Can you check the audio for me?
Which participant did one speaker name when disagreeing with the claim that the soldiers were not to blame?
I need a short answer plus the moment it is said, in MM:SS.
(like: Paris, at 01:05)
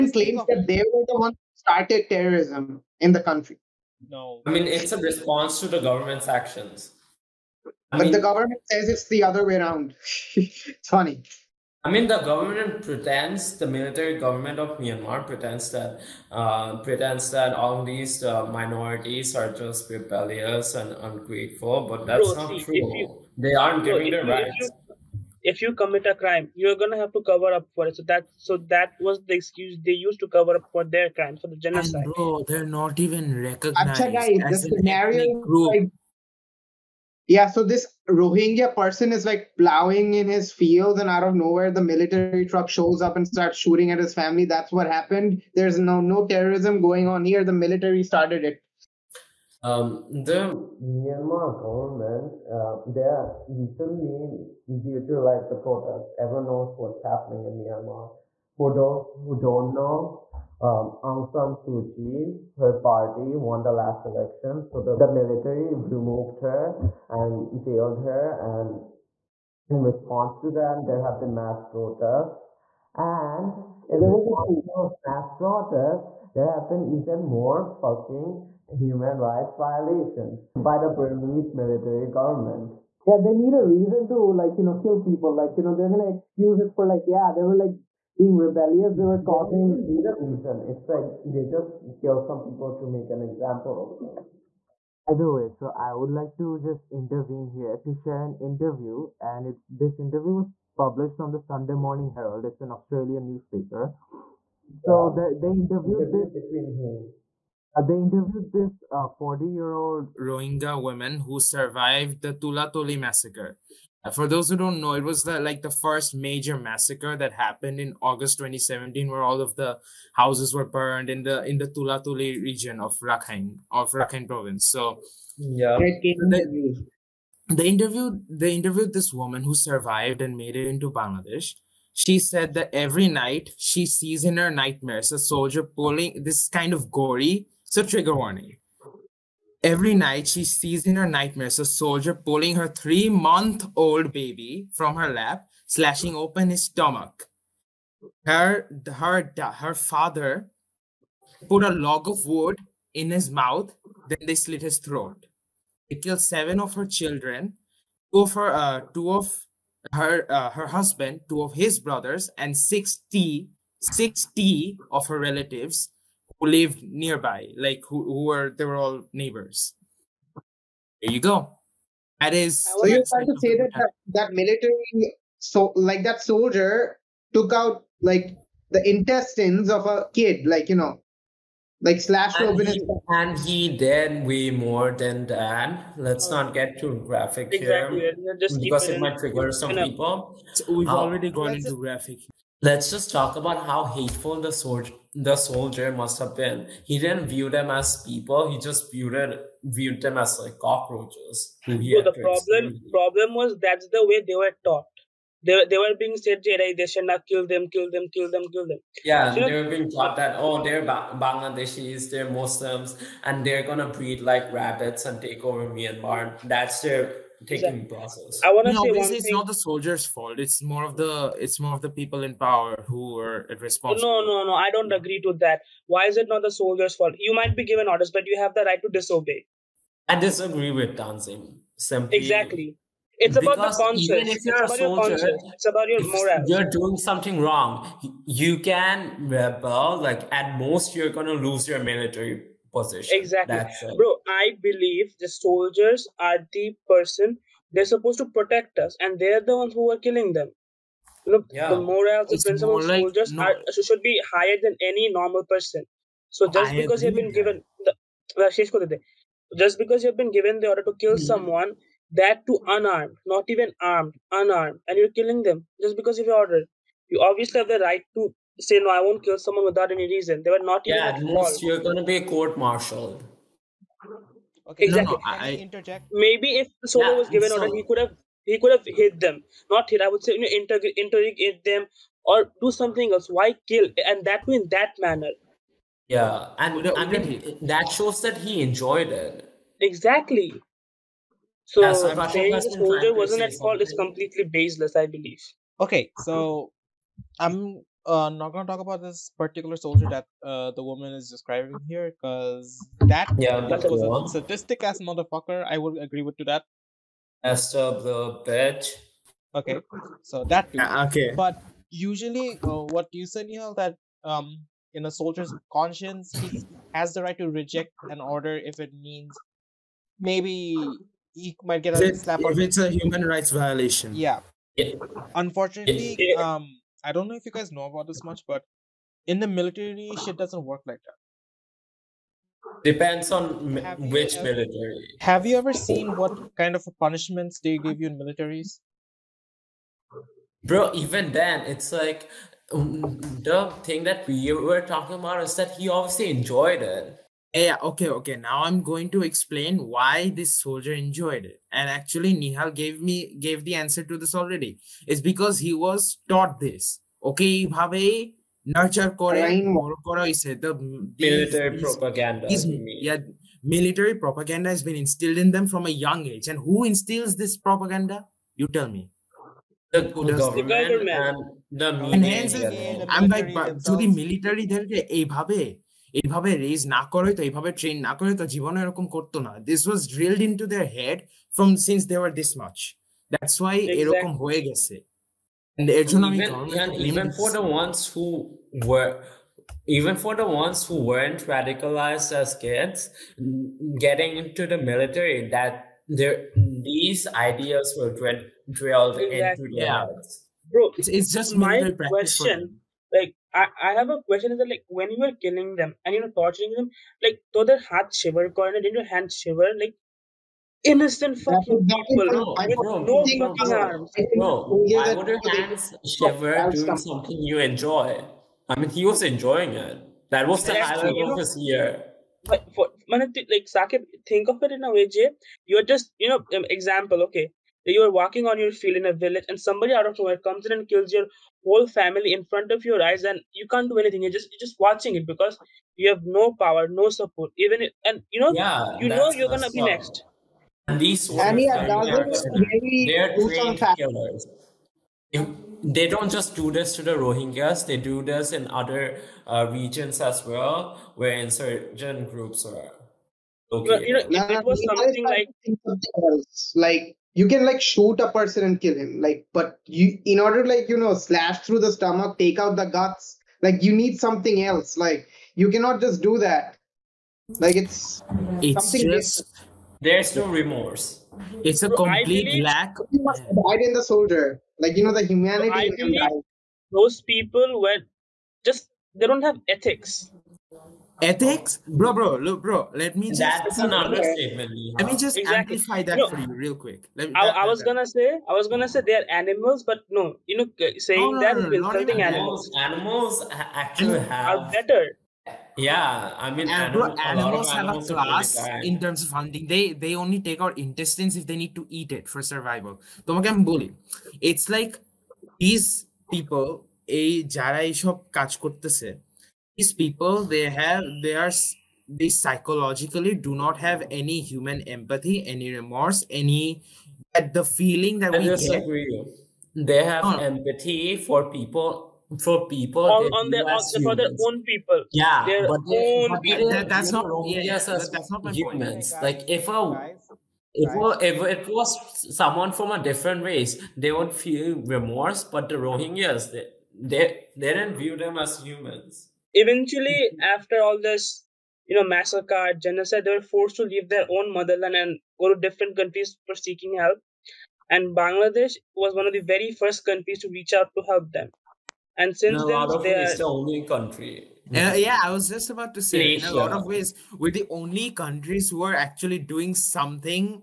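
Tanzim, at 03:50.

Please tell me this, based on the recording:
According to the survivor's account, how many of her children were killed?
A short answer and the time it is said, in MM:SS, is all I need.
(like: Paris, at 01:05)
7, at 02:36.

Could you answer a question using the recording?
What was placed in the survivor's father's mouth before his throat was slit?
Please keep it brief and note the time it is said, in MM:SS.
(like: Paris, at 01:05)
A log of wood, at 02:31.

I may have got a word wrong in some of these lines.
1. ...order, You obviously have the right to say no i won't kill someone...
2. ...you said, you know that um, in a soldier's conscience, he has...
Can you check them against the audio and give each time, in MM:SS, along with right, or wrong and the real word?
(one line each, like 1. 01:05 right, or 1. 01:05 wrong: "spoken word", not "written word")
1. 04:26 right
2. 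05:13 right.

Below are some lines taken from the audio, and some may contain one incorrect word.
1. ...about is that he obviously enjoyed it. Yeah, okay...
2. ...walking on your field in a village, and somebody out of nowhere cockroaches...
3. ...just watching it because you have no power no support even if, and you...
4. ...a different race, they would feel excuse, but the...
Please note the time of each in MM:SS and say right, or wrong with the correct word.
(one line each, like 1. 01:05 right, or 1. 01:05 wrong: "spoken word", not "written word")
1. 05:45 right
2. 07:08 wrong: "comes", not "cockroaches"
3. 07:14 right
4. 08:52 wrong: "remorse", not "excuse".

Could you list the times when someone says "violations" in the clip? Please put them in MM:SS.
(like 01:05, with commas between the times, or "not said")
01:19, 05:23.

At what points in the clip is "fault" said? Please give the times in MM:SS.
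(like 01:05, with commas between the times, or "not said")
03:40, 03:46, 04:53.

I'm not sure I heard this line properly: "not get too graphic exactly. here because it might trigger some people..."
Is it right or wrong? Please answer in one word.
right.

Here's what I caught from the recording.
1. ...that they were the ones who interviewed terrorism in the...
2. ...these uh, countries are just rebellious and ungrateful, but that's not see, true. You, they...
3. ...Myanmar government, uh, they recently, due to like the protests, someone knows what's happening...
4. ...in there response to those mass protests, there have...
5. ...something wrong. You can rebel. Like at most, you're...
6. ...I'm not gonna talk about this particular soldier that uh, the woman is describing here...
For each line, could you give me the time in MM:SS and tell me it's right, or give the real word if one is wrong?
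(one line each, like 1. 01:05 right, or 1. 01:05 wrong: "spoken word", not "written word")
1. 00:00 wrong: "started", not "interviewed"
2. 00:17 wrong: "minorities", not "countries"
3. 00:50 wrong: "everyone", not "someone"
4. 01:13 right
5. 03:56 right
6. 04:58 right.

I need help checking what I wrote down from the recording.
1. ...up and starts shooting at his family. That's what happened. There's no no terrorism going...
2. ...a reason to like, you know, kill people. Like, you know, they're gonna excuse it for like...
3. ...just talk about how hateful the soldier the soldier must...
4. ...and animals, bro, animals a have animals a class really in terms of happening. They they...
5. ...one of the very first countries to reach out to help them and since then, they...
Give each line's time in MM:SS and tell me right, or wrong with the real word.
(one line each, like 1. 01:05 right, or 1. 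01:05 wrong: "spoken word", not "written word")
1. 00:43 right
2. 01:23 right
3. 03:12 right
4. 08:16 wrong: "hunting", not "happening"
5. 09:09 right.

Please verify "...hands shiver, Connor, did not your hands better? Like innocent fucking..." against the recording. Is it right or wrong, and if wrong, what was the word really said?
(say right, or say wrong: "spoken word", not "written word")
wrong: "shiver", not "better".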